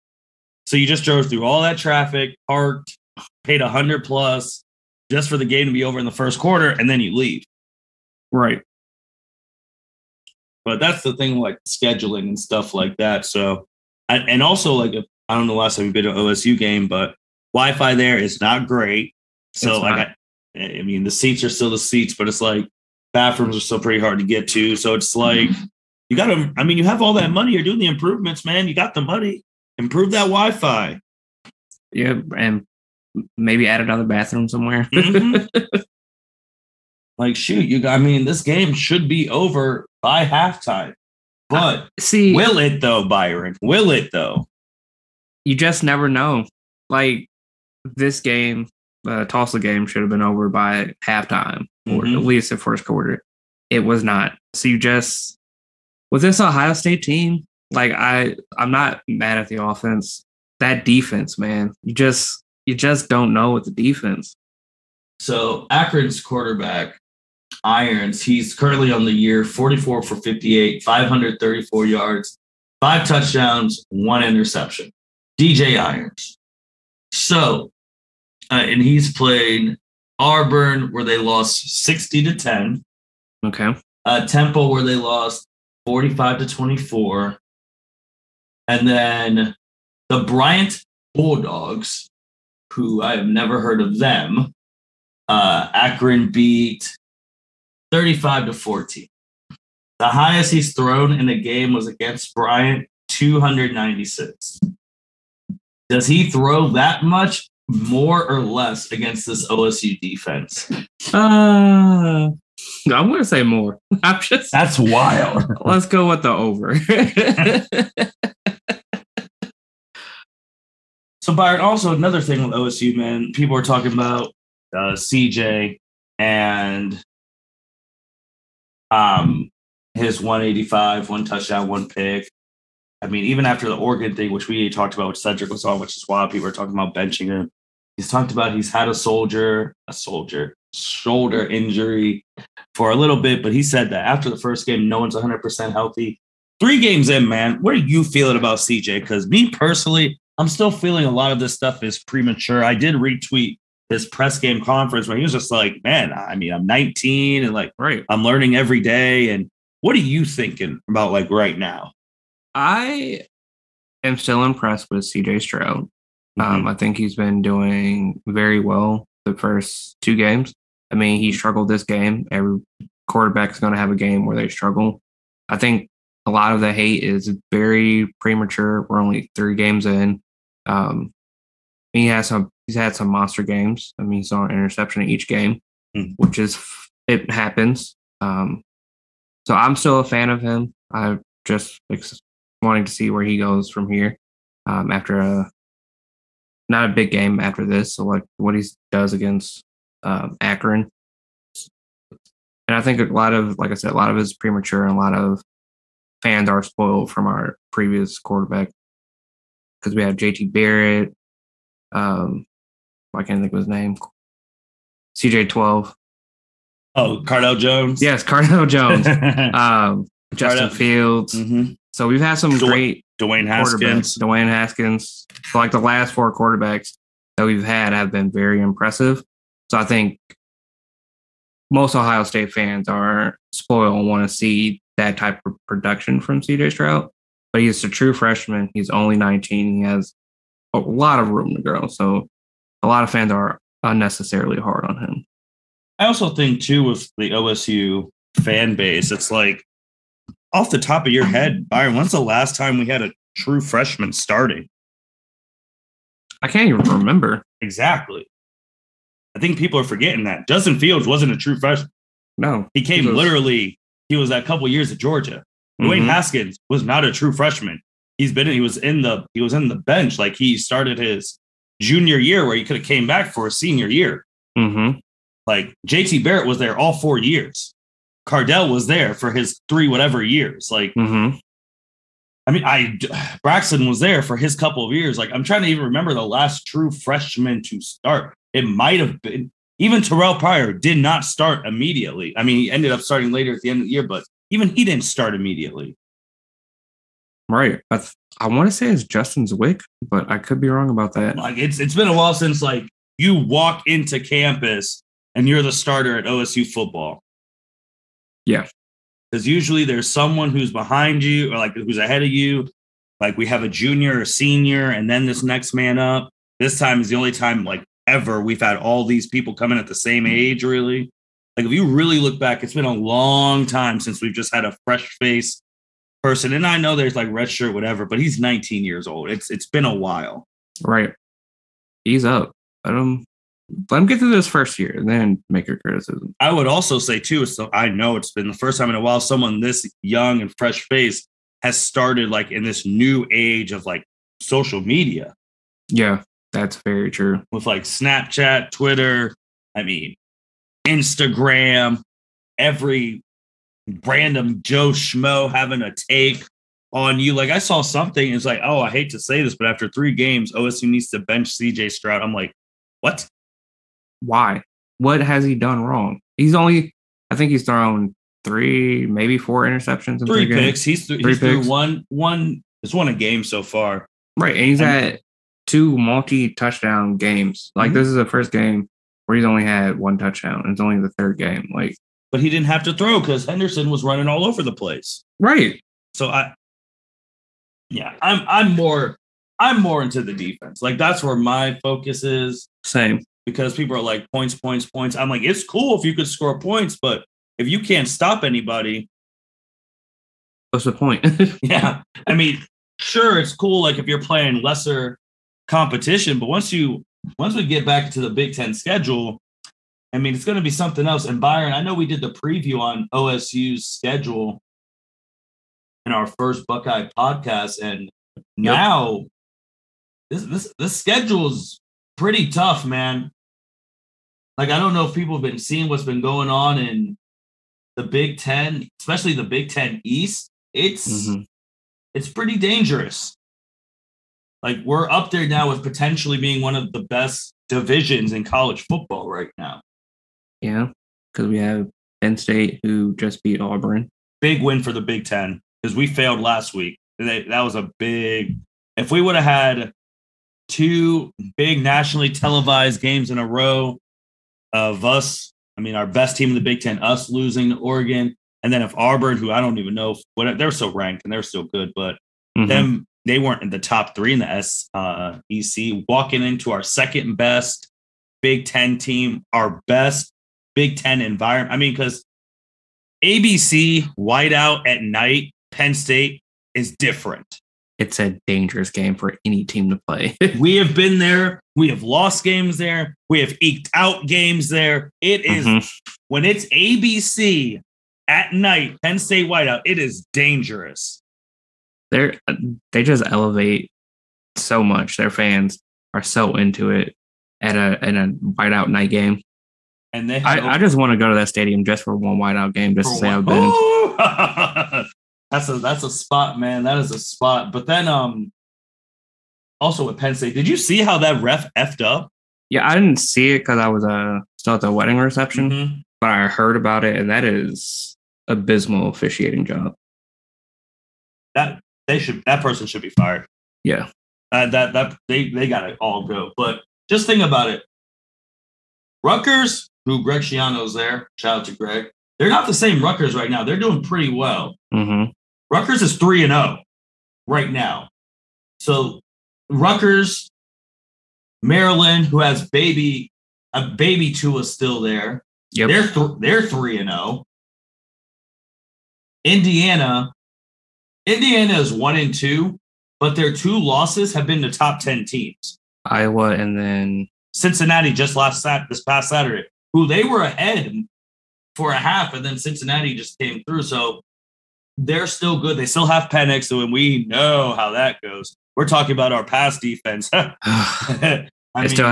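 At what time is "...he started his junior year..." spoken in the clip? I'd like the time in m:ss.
4:30.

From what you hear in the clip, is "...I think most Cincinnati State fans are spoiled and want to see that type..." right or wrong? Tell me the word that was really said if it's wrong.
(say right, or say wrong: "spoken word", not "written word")
wrong: "Ohio", not "Cincinnati".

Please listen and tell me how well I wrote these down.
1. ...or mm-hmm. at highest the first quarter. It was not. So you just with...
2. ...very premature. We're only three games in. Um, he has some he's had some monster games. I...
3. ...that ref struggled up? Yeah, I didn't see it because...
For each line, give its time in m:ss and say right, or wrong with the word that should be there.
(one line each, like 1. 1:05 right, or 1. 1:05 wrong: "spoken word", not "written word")
1. 0:51 wrong: "least", not "highest"
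2. 2:57 right
3. 8:31 wrong: "effed", not "struggled".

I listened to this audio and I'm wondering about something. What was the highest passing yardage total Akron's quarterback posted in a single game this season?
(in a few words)
296.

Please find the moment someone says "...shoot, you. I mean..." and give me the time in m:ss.
0:37.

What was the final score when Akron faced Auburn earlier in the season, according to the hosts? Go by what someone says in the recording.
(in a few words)
60 to 10.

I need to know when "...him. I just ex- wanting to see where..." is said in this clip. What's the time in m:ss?
3:10.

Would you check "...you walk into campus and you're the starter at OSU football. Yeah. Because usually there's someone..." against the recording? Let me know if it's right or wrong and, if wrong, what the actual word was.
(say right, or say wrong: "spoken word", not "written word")
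right.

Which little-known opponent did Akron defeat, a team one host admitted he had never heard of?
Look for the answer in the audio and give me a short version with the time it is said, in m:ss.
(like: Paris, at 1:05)
Bryant Bulldogs, at 1:30.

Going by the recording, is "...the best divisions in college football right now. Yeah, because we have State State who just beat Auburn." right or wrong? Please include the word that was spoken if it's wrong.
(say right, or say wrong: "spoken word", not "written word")
wrong: "Penn", not "State".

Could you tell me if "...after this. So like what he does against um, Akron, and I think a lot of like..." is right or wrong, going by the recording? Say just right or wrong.
right.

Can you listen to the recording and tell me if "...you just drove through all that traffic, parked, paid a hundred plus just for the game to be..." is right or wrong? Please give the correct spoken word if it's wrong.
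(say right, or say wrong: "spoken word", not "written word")
right.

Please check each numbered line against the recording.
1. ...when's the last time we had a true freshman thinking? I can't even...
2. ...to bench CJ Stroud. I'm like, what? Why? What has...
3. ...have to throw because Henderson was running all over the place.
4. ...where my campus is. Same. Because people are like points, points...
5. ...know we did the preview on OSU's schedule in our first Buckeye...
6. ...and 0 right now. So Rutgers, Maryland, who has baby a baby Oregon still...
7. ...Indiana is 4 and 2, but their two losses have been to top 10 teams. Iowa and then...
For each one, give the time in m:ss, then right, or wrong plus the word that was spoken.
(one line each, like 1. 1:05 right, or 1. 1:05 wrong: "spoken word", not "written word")
1. 4:11 wrong: "starting", not "thinking"
2. 6:01 right
3. 6:22 right
4. 6:31 wrong: "focus", not "campus"
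5. 6:51 right
6. 8:56 wrong: "Tua", not "Oregon"
7. 9:11 wrong: "1", not "4".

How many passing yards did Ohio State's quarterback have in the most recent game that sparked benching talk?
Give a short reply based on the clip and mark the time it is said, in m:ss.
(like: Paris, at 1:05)
185, at 2:10.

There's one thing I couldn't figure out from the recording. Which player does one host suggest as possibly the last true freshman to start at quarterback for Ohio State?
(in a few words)
Justin Zwick.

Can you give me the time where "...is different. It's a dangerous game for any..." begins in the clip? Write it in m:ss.
7:56.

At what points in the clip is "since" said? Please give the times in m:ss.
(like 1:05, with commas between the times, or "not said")
5:02, 5:24.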